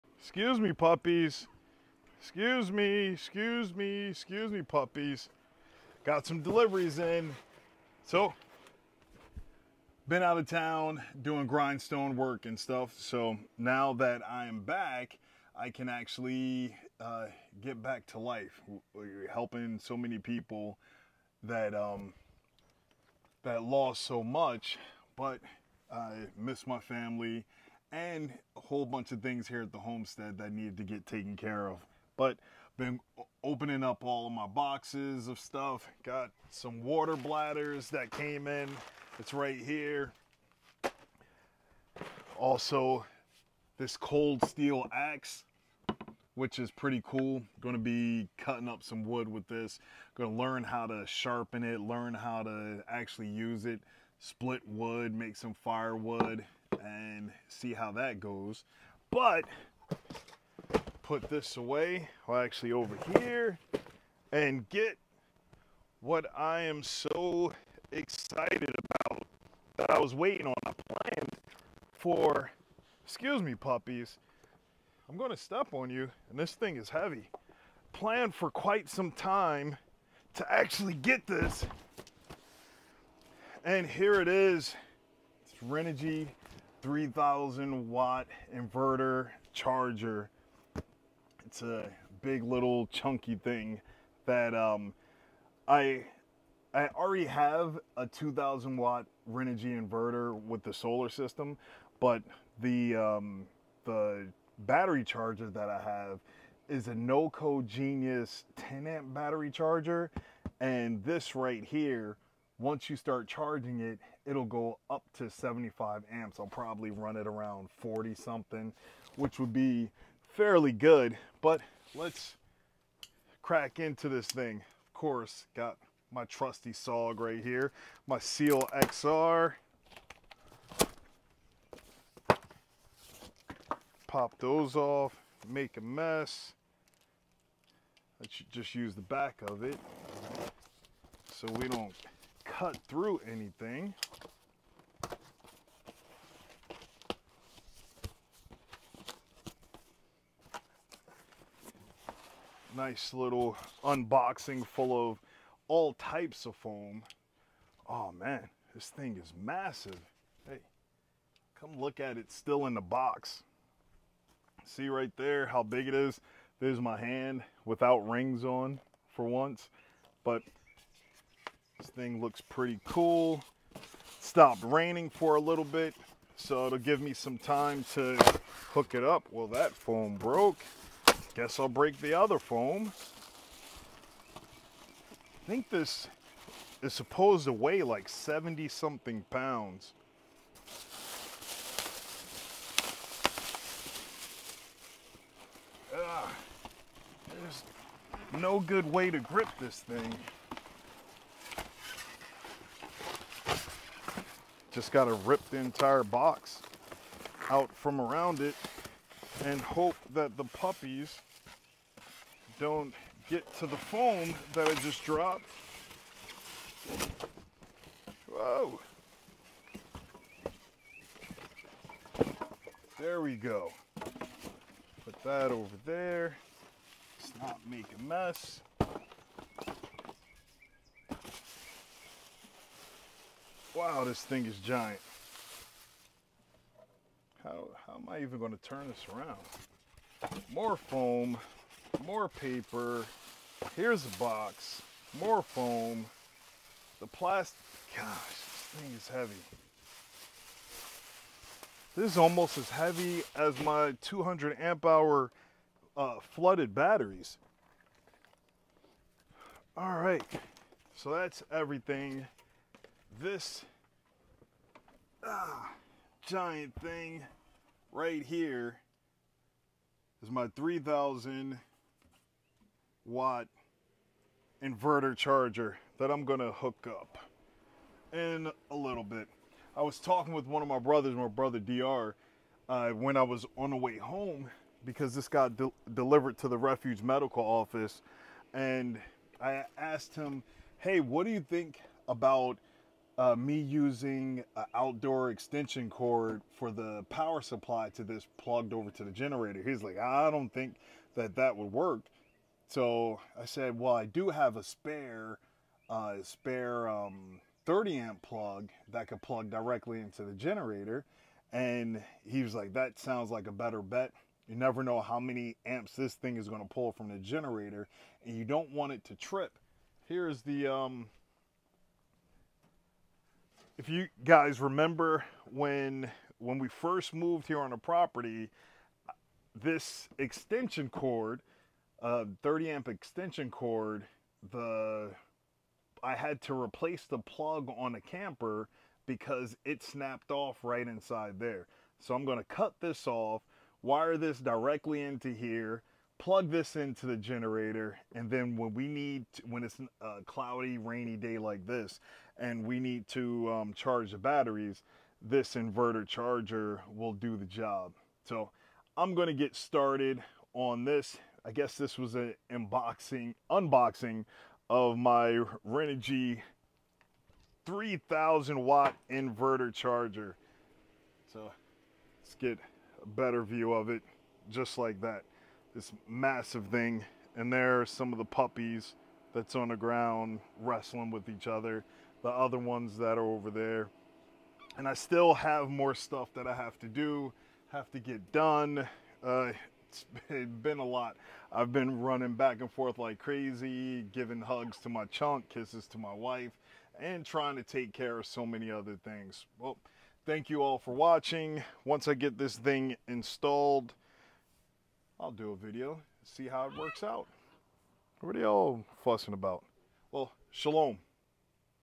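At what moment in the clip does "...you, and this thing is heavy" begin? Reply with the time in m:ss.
1:15.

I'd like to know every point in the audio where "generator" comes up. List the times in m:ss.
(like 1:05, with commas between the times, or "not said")
4:59, 5:10, 5:17, 5:47.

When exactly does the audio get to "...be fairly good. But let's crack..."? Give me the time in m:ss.
1:59.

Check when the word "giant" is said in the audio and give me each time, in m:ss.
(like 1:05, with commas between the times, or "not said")
3:54, 4:26.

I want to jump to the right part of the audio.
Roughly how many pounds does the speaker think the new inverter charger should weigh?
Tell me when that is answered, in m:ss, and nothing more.
3:08.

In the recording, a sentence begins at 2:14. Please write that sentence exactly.
Pop those off, make a mess.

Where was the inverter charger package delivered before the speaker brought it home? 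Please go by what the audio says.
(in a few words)
refuge medical office.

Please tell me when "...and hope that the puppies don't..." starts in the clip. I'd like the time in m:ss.
3:29.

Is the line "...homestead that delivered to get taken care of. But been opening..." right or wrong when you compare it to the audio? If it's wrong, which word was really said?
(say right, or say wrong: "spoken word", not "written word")
wrong: "needed", not "delivered".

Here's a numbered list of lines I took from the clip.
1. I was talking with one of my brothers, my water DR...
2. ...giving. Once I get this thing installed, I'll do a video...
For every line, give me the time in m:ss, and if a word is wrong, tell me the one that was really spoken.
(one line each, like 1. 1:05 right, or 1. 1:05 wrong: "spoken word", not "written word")
1. 4:39 wrong: "brother", not "water"
2. 6:40 wrong: "watching", not "giving".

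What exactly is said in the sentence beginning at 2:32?
Nice little unboxing full of all types of foam.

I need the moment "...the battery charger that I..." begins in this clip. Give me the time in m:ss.
1:43.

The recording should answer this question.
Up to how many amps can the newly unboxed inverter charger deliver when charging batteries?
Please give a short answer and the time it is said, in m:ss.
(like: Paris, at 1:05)
75 amps, at 1:55.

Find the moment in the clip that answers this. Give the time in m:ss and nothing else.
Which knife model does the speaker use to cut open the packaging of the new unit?
2:08.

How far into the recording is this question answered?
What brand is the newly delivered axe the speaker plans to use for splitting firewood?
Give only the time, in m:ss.
0:43.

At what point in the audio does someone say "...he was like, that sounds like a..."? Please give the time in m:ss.
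5:12.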